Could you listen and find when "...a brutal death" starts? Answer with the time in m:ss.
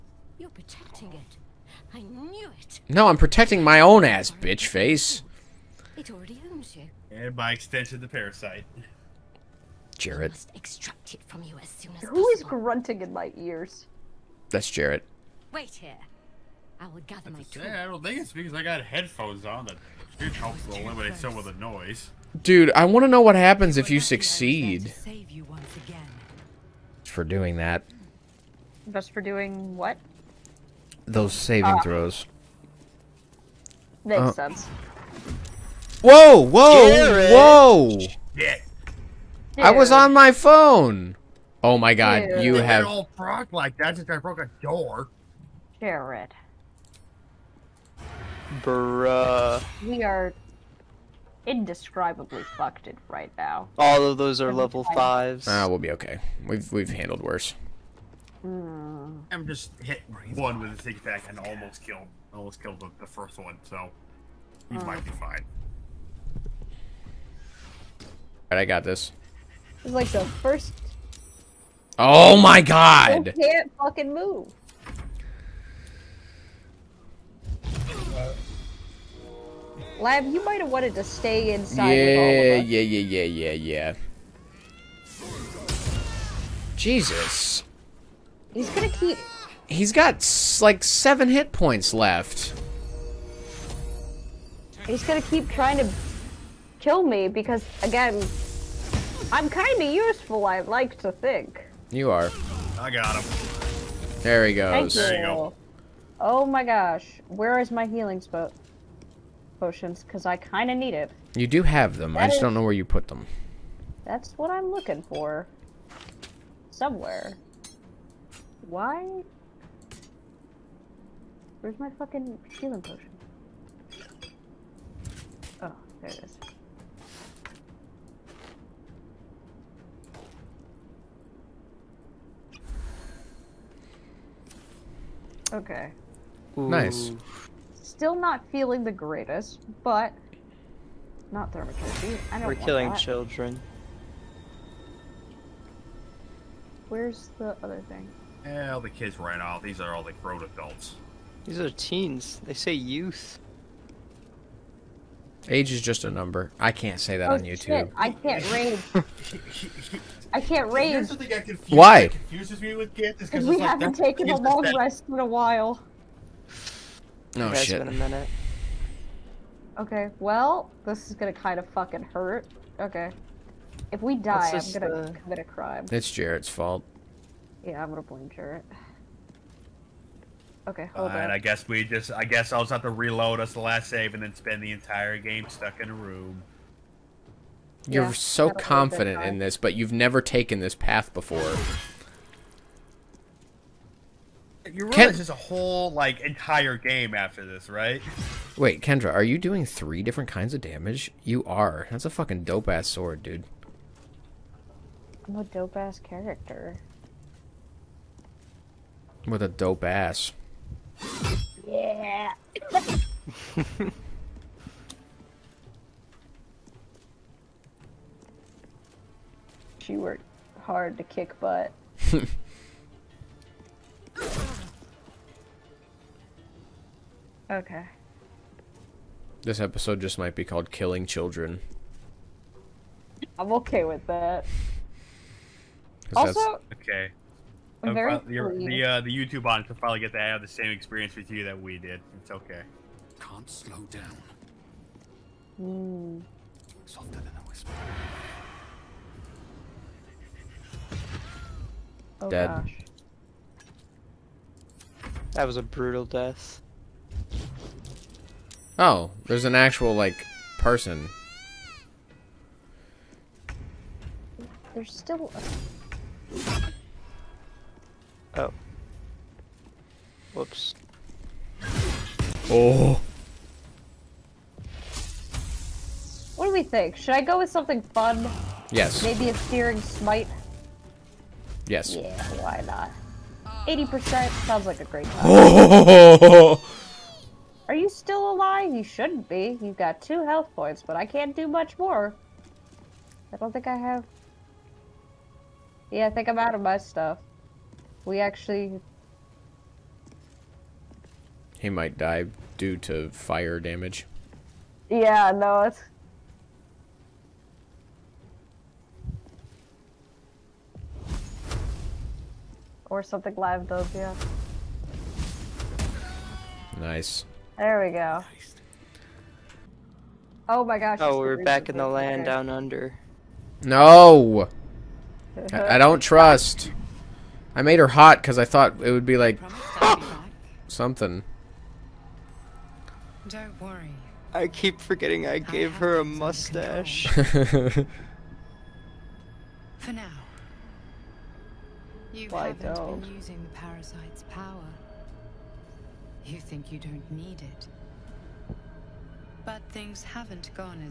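4:15.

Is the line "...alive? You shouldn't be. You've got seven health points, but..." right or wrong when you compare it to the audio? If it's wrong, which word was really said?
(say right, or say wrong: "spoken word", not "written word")
wrong: "two", not "seven".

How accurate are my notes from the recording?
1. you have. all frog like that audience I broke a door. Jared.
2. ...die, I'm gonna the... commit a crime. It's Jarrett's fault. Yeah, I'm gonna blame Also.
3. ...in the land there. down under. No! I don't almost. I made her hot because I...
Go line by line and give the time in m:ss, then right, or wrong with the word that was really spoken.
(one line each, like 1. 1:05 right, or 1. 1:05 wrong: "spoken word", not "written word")
1. 0:42 wrong: "since", not "audience"
2. 2:54 wrong: "Jarrett", not "Also"
3. 5:21 wrong: "trust", not "almost".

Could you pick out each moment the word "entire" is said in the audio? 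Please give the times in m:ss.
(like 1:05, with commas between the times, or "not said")
3:04, 3:16.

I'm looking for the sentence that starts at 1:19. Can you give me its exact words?
Lab, you might have wanted to stay inside.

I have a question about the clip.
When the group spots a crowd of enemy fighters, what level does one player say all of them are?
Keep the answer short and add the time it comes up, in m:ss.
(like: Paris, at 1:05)
5, at 0:54.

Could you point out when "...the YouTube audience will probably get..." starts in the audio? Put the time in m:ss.
3:59.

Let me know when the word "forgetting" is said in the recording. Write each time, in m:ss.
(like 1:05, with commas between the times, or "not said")
5:34.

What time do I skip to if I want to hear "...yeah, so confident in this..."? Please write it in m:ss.
3:08.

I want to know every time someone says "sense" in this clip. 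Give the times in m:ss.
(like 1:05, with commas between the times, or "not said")
0:34.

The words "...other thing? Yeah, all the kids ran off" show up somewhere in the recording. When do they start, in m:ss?
2:27.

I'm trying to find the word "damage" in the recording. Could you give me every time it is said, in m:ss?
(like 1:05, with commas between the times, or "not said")
3:20, 5:03.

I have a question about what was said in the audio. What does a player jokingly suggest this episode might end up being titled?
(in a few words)
Killing Children.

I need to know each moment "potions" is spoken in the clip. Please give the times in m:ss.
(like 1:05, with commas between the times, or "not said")
1:49, 2:02.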